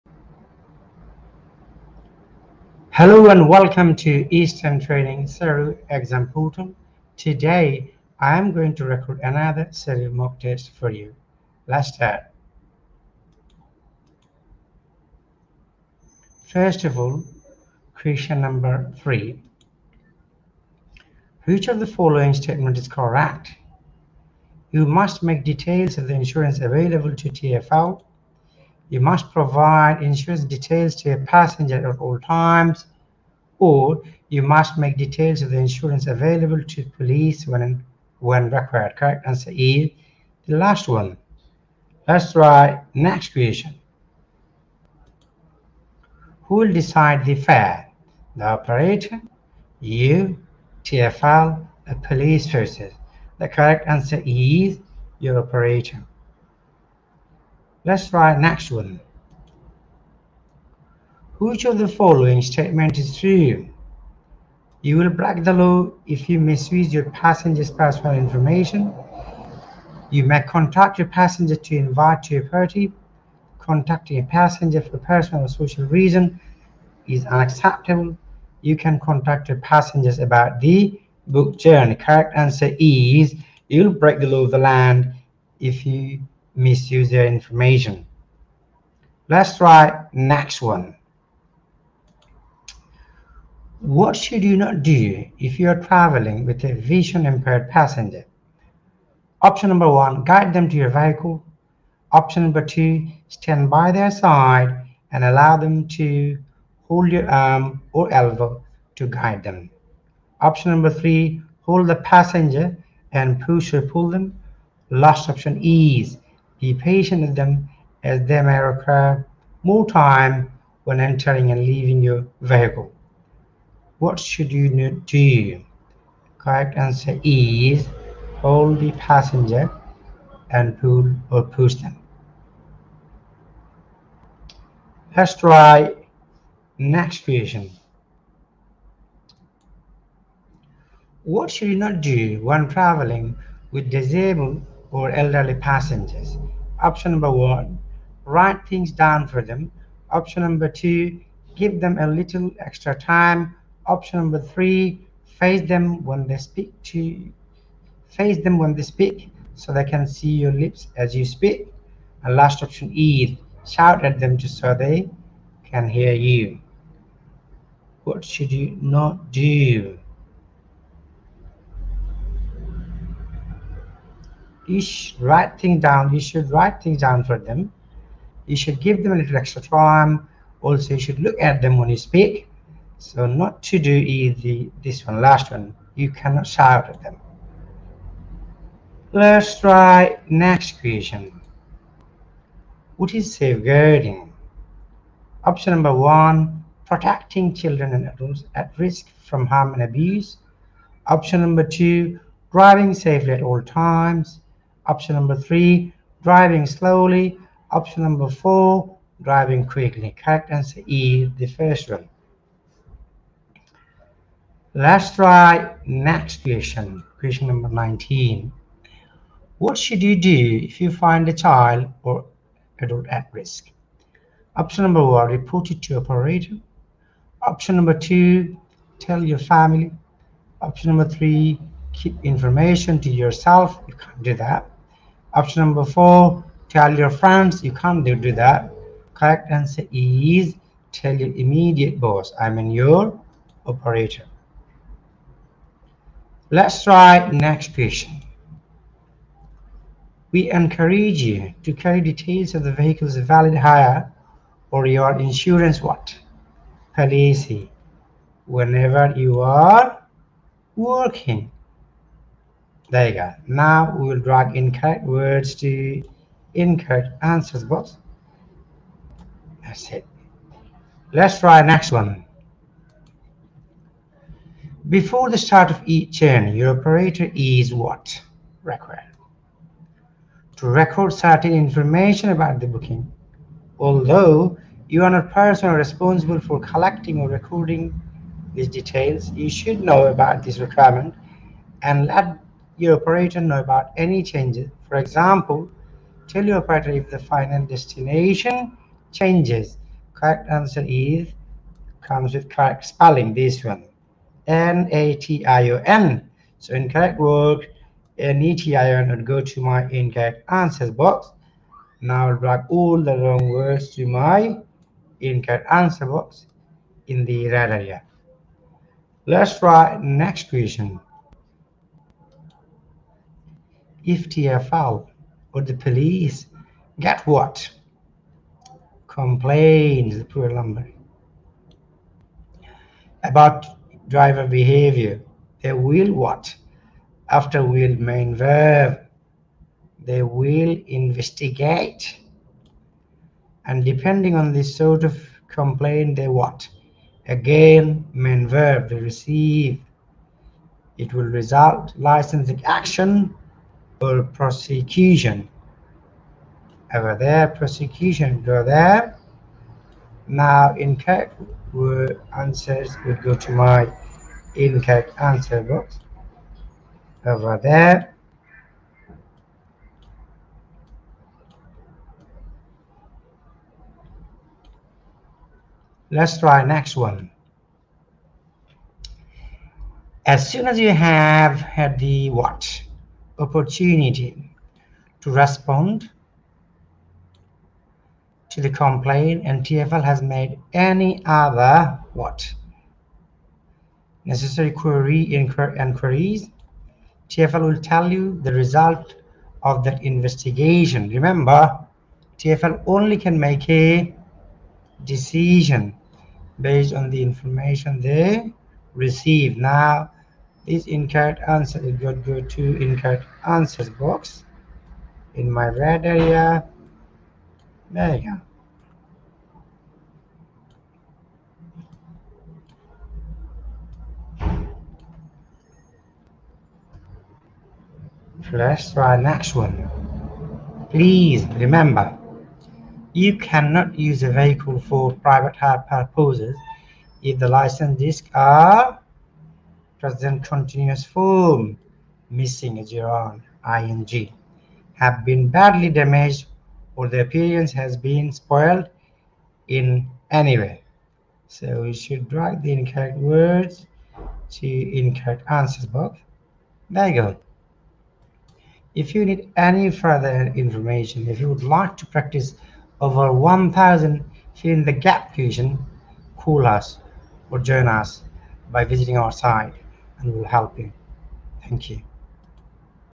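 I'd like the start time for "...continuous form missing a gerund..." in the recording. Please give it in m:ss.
7:20.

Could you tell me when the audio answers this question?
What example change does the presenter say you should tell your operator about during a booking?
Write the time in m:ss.
4:57.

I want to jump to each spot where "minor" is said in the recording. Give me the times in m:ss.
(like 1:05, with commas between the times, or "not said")
not said.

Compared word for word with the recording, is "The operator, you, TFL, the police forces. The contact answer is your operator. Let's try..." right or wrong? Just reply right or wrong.
wrong.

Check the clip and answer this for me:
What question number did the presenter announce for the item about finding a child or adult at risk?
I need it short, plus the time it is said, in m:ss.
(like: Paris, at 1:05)
19, at 3:37.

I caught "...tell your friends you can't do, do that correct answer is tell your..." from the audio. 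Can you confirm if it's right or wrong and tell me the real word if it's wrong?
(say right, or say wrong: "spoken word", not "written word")
right.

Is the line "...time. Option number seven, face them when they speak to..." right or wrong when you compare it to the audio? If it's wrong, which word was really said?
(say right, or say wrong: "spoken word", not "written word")
wrong: "three", not "seven".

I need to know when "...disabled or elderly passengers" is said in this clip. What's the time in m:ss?
2:23.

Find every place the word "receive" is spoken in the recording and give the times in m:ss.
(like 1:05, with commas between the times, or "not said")
5:48, 6:48.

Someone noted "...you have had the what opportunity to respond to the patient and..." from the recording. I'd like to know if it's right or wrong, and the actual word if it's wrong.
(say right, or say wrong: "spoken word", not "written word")
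wrong: "complaint", not "patient".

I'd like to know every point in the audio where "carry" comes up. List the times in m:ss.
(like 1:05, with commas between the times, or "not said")
4:11.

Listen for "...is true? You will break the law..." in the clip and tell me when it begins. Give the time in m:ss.
1:02.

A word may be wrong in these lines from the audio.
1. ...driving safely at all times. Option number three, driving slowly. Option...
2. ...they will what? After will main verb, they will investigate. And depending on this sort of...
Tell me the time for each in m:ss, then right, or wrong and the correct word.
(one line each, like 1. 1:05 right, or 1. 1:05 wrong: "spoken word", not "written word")
1. 3:22 right
2. 5:35 right.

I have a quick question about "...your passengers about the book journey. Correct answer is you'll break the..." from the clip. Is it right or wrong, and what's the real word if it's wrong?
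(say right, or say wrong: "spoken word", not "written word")
right.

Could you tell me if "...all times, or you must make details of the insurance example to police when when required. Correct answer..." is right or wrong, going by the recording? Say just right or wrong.
wrong.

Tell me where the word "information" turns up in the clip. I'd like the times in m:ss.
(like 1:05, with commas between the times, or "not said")
1:08, 1:27, 3:52, 4:41, 6:47, 7:40.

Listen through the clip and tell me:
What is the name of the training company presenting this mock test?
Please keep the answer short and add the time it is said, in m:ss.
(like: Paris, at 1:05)
Eastend Training, at 0:04.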